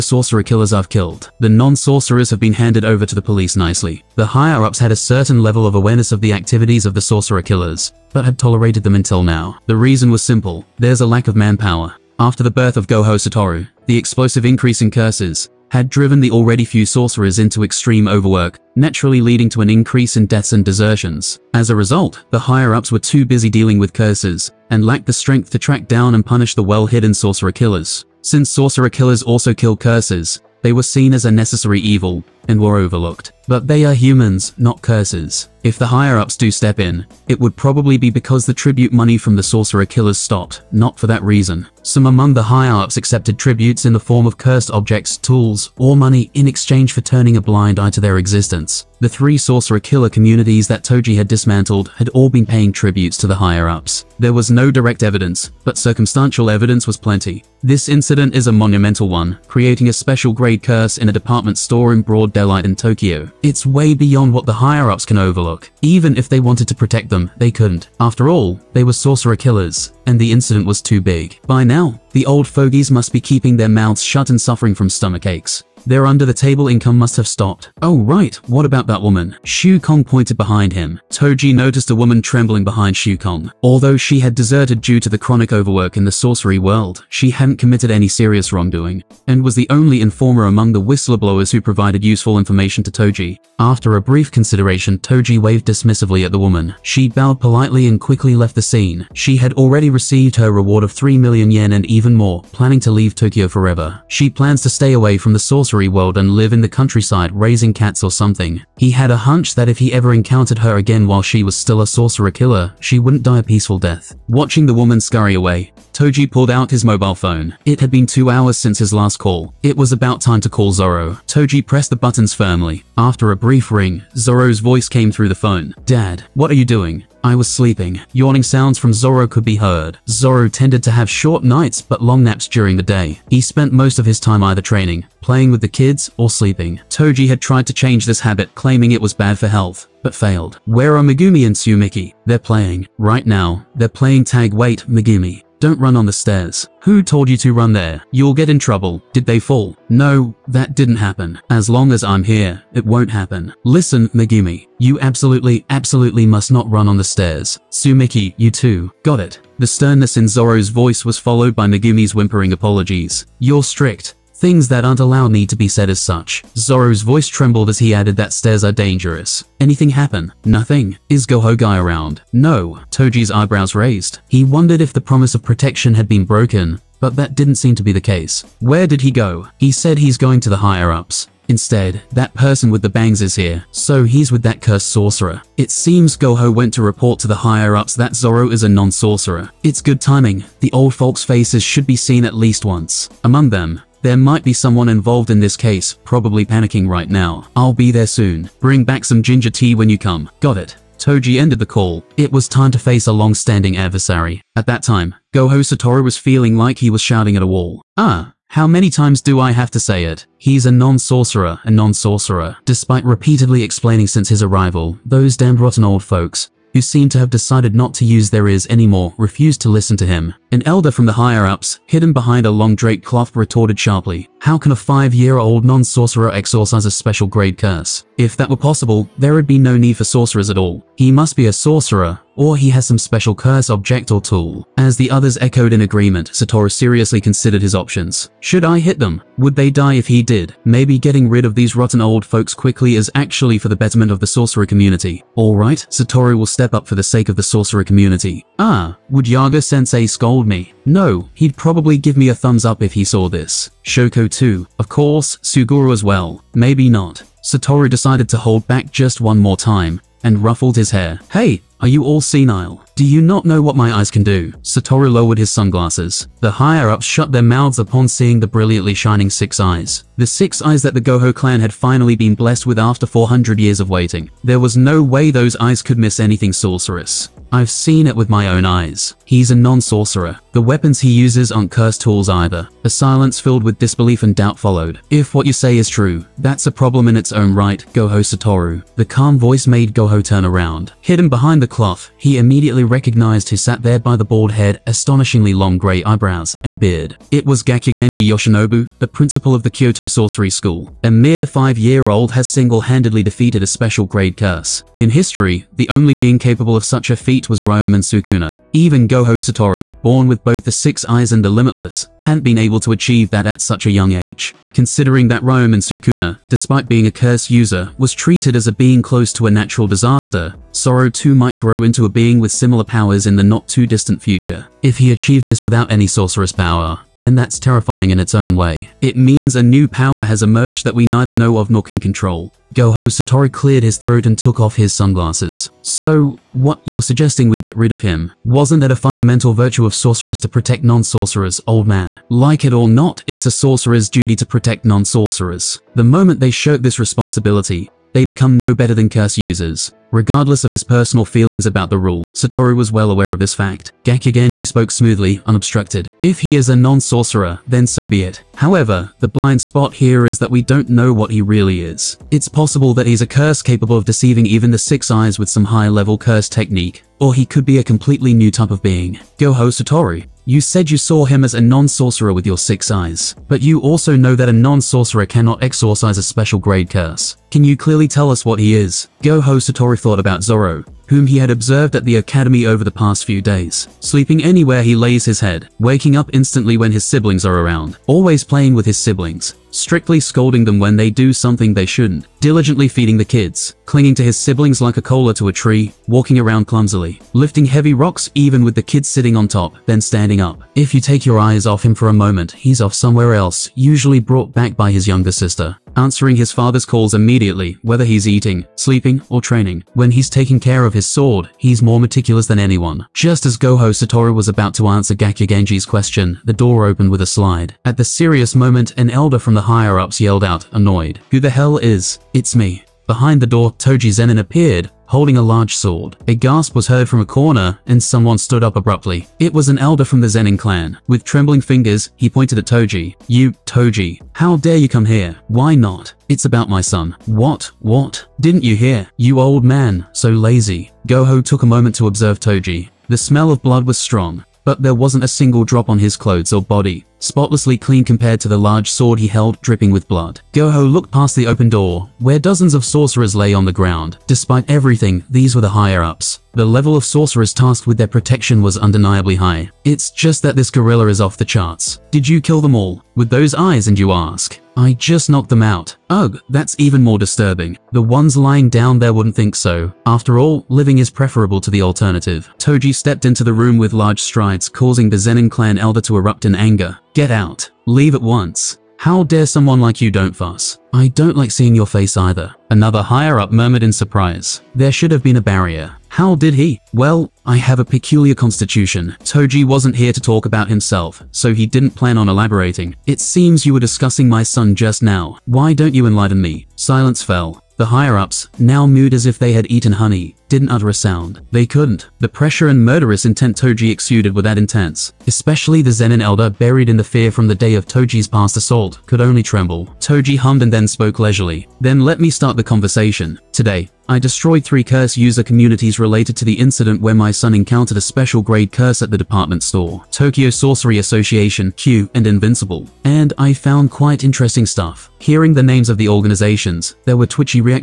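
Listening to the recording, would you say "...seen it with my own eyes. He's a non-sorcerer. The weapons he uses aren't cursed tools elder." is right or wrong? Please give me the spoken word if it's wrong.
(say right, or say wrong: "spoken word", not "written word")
wrong: "either", not "elder".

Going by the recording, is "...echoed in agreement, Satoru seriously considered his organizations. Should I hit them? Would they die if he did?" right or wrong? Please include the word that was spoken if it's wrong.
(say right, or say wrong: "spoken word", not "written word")
wrong: "options", not "organizations".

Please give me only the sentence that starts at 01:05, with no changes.
Even if they wanted to protect them, they couldn't.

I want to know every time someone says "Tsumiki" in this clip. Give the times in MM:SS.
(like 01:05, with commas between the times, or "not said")
02:21, 02:37.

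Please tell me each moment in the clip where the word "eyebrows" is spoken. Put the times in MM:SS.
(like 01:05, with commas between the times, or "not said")
02:53, 04:56.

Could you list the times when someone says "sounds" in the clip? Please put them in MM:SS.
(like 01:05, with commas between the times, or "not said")
02:08, 08:20.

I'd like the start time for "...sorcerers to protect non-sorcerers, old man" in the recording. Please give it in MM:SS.
05:39.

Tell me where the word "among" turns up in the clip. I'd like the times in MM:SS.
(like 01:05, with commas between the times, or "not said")
00:42, 01:30, 03:13.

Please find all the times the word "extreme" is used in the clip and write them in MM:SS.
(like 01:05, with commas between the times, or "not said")
00:17.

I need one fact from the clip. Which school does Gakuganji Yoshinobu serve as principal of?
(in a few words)
Kyoto Sorcery School.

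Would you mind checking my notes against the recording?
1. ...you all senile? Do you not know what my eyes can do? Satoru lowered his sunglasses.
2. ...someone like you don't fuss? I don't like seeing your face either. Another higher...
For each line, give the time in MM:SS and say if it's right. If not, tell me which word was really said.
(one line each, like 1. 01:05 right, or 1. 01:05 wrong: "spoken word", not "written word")
1. 04:21 right
2. 07:59 right.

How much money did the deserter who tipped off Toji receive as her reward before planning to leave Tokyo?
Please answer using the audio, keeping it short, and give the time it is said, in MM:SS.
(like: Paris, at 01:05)
3 million yen, at 01:40.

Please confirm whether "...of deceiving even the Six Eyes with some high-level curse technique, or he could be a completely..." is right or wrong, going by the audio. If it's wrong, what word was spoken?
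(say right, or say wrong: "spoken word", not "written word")
right.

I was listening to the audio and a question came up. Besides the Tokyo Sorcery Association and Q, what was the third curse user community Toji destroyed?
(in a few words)
Invincible.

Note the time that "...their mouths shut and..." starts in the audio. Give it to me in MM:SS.
01:13.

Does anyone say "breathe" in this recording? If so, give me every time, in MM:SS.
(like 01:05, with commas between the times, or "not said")
not said.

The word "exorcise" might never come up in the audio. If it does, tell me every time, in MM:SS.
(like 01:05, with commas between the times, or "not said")
03:46, 06:15.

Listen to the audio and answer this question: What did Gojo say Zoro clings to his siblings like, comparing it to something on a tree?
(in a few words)
a cola.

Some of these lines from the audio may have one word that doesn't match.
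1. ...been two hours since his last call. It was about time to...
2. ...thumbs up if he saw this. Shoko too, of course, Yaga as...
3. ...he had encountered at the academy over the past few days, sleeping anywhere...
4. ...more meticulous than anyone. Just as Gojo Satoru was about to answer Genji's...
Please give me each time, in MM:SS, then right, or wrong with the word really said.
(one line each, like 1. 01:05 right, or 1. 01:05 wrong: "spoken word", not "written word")
1. 01:57 right
2. 04:12 wrong: "Suguru", not "Yaga"
3. 06:21 wrong: "observed", not "encountered"
4. 06:51 right.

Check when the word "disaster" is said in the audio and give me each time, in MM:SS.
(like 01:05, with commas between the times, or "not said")
05:19.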